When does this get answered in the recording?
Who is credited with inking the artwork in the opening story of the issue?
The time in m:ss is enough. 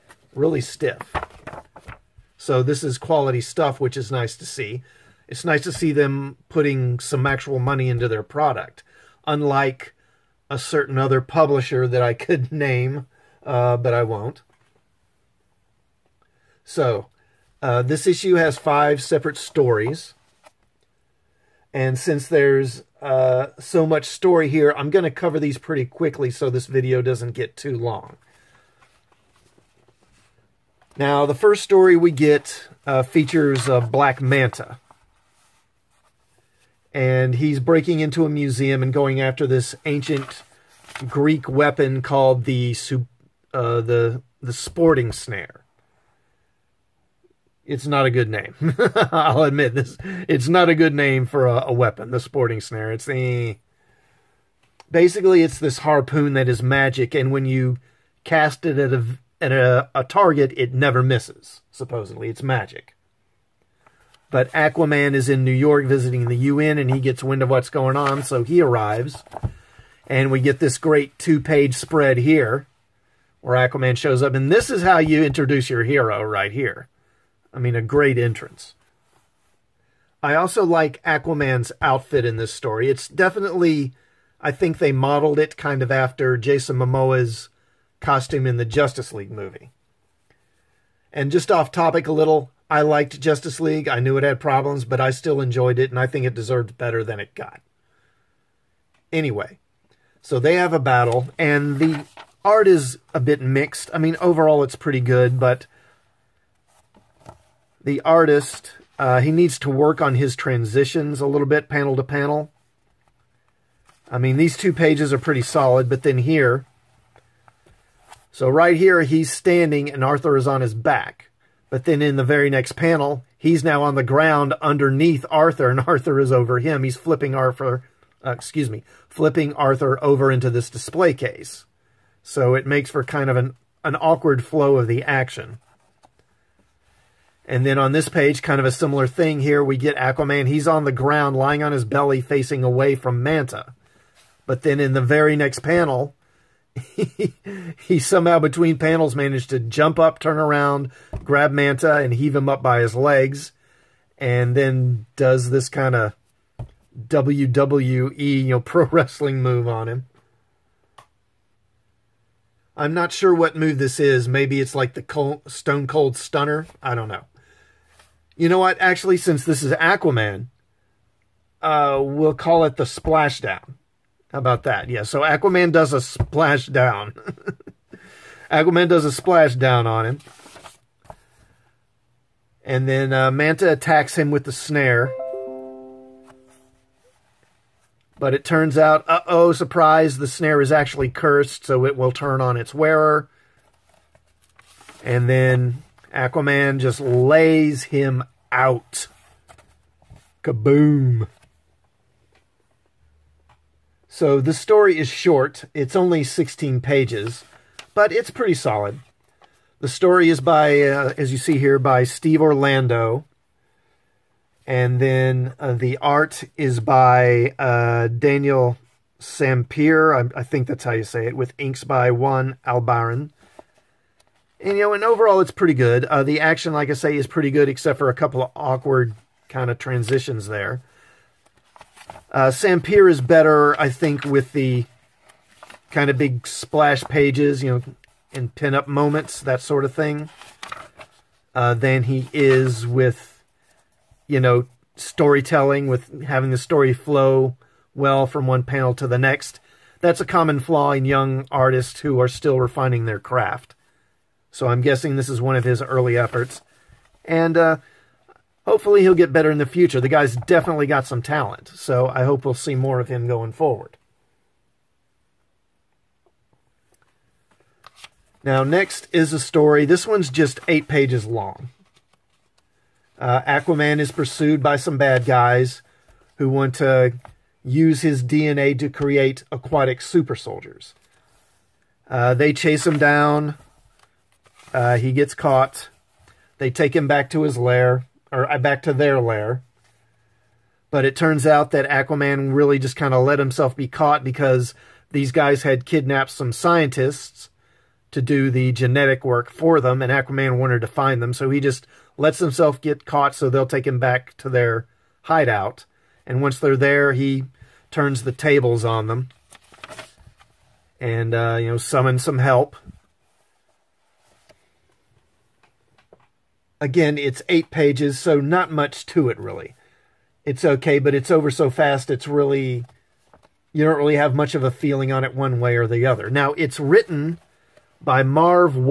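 3:42.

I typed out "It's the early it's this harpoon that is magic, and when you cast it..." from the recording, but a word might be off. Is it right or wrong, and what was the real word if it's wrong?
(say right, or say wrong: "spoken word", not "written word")
wrong: "basically", not "early".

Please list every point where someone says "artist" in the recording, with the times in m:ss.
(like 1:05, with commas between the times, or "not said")
1:48, 4:11.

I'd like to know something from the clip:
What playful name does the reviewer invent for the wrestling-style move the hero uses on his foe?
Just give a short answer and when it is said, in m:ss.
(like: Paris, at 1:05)
The Splashdown, at 2:52.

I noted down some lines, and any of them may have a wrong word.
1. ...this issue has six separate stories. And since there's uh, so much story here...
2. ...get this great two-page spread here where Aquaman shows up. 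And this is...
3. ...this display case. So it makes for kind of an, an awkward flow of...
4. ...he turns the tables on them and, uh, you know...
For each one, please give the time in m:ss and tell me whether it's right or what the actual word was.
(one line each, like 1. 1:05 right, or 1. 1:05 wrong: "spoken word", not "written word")
1. 0:17 wrong: "five", not "six"
2. 1:10 right
3. 2:10 right
4. 5:07 right.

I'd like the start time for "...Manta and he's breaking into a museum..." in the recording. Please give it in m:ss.
0:34.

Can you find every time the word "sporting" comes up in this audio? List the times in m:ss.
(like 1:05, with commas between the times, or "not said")
0:44, 0:52.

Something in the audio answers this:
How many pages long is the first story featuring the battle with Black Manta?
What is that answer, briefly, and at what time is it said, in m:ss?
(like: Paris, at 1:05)
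16, at 3:26.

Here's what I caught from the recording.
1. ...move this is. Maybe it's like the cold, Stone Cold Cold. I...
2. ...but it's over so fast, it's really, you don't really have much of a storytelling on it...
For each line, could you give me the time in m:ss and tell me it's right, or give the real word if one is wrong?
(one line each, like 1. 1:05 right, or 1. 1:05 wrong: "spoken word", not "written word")
1. 2:43 wrong: "Stunner", not "Cold"
2. 5:20 wrong: "feeling", not "storytelling".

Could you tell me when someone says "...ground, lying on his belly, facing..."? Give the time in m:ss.
2:20.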